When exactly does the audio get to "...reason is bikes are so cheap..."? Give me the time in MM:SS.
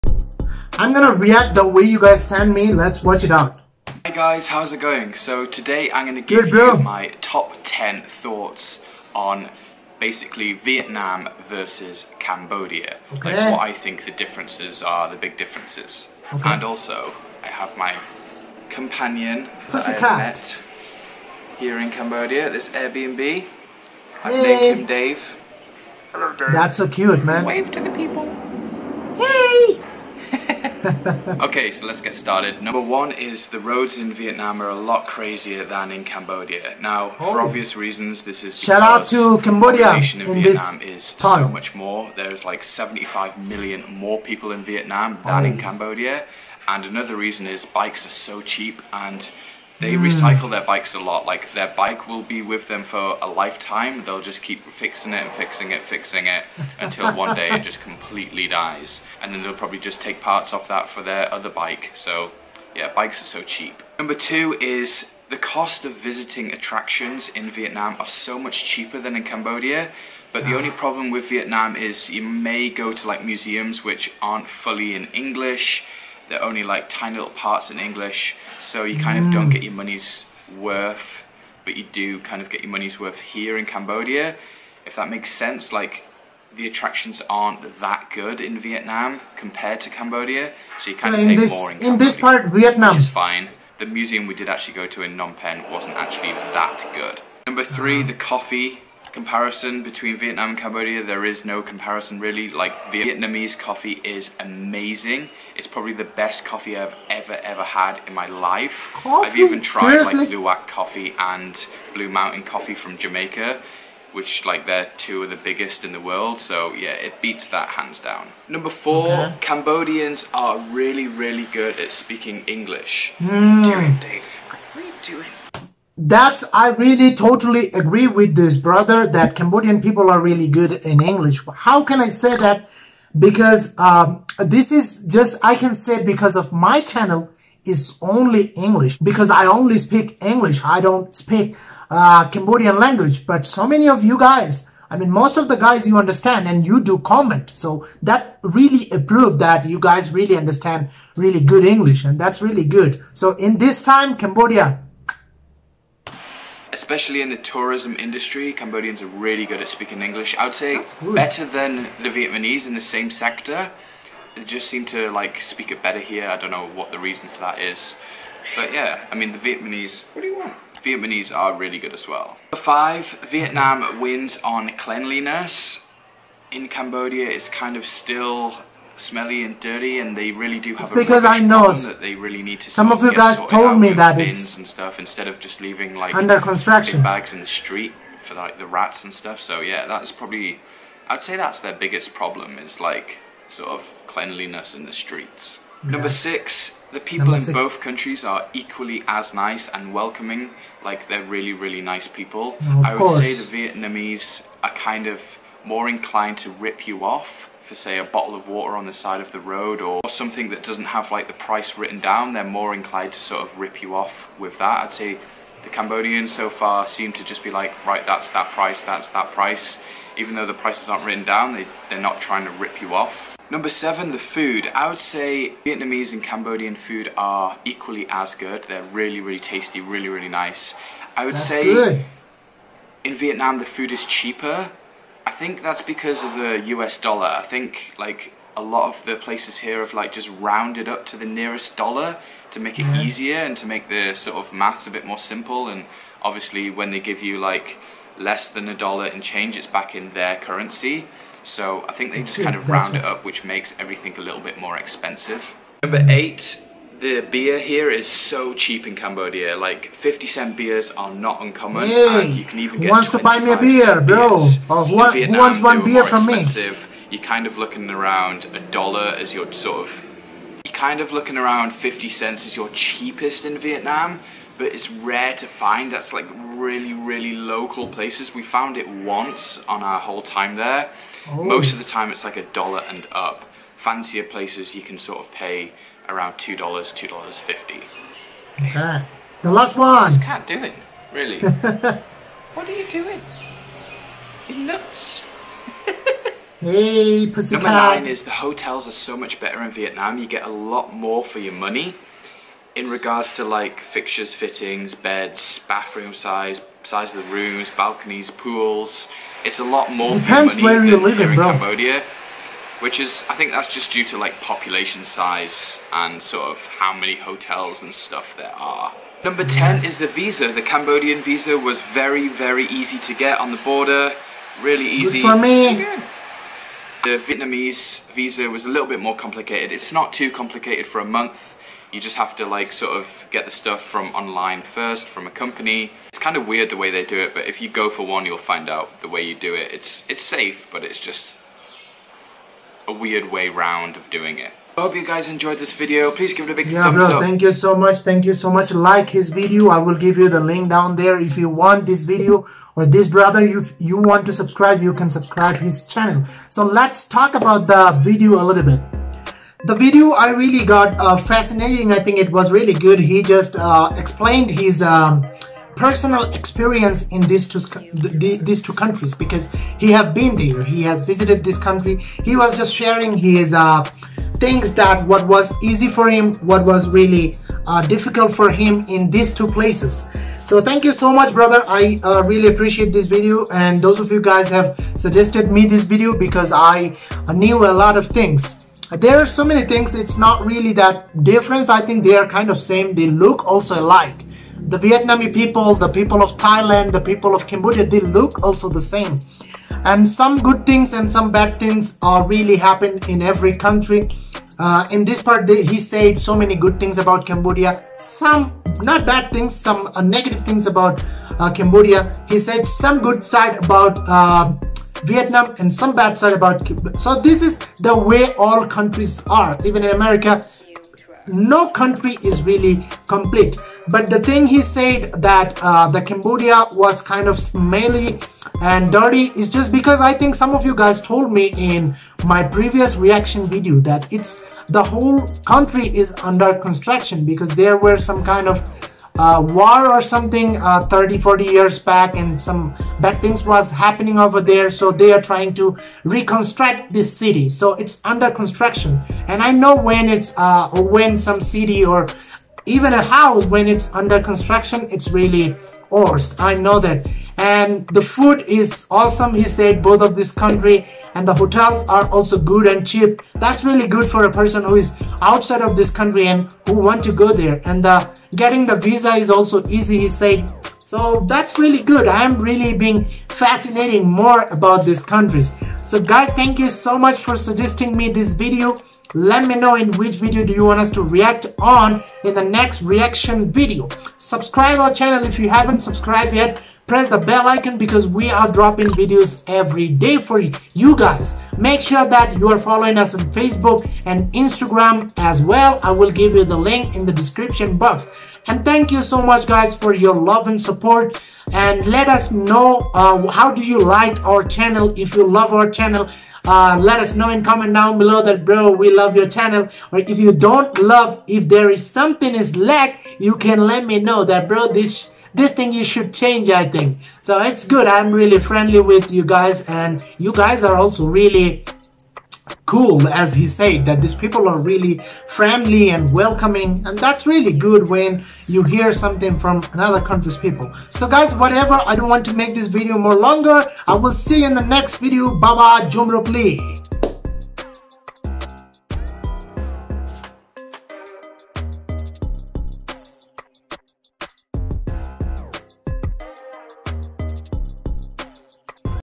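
00:47.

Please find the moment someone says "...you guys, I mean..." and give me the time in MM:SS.
02:24.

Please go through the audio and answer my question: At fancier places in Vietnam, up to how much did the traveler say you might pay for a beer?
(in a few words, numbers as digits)
$2.50.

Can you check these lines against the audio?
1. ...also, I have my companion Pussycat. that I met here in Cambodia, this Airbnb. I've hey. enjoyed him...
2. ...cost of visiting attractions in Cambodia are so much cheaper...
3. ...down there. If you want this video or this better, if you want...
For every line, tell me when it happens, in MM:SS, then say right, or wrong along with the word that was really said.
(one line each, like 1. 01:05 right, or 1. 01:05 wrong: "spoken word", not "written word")
1. 00:16 wrong: "named", not "enjoyed"
2. 01:05 wrong: "Vietnam", not "Cambodia"
3. 05:50 wrong: "brother", not "better".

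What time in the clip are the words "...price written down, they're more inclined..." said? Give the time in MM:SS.
03:31.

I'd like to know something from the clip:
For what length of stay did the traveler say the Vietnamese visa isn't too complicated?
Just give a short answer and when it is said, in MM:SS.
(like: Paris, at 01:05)
a month, at 05:30.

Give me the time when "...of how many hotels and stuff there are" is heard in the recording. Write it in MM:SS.
05:16.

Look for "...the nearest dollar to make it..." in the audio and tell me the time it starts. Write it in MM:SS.
04:01.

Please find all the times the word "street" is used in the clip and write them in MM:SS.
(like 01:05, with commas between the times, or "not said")
03:07, 03:14.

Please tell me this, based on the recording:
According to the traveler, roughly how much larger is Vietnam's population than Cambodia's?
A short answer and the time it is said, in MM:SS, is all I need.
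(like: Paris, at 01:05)
75 million, at 00:42.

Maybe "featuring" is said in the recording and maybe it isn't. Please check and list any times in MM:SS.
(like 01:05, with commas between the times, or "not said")
not said.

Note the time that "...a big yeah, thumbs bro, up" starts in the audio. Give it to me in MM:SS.
05:46.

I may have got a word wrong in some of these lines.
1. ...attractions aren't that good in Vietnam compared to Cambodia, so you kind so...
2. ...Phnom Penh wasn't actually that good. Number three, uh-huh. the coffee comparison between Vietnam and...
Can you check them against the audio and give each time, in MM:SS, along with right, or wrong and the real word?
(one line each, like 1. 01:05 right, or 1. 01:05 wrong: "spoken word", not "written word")
1. 01:26 right
2. 01:35 right.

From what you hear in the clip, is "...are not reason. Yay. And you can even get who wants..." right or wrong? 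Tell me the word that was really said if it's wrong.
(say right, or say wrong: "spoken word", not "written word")
wrong: "uncommon", not "reason".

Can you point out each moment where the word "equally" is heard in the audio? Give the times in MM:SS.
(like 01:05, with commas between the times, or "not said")
03:18, 03:47.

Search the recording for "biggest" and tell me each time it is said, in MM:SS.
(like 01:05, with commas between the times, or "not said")
01:55, 03:11.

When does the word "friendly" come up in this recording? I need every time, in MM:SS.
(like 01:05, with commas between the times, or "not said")
08:38, 08:45.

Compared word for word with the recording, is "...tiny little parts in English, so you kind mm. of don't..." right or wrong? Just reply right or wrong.
right.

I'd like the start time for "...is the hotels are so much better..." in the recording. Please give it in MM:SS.
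04:58.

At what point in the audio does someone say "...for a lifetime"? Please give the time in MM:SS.
00:52.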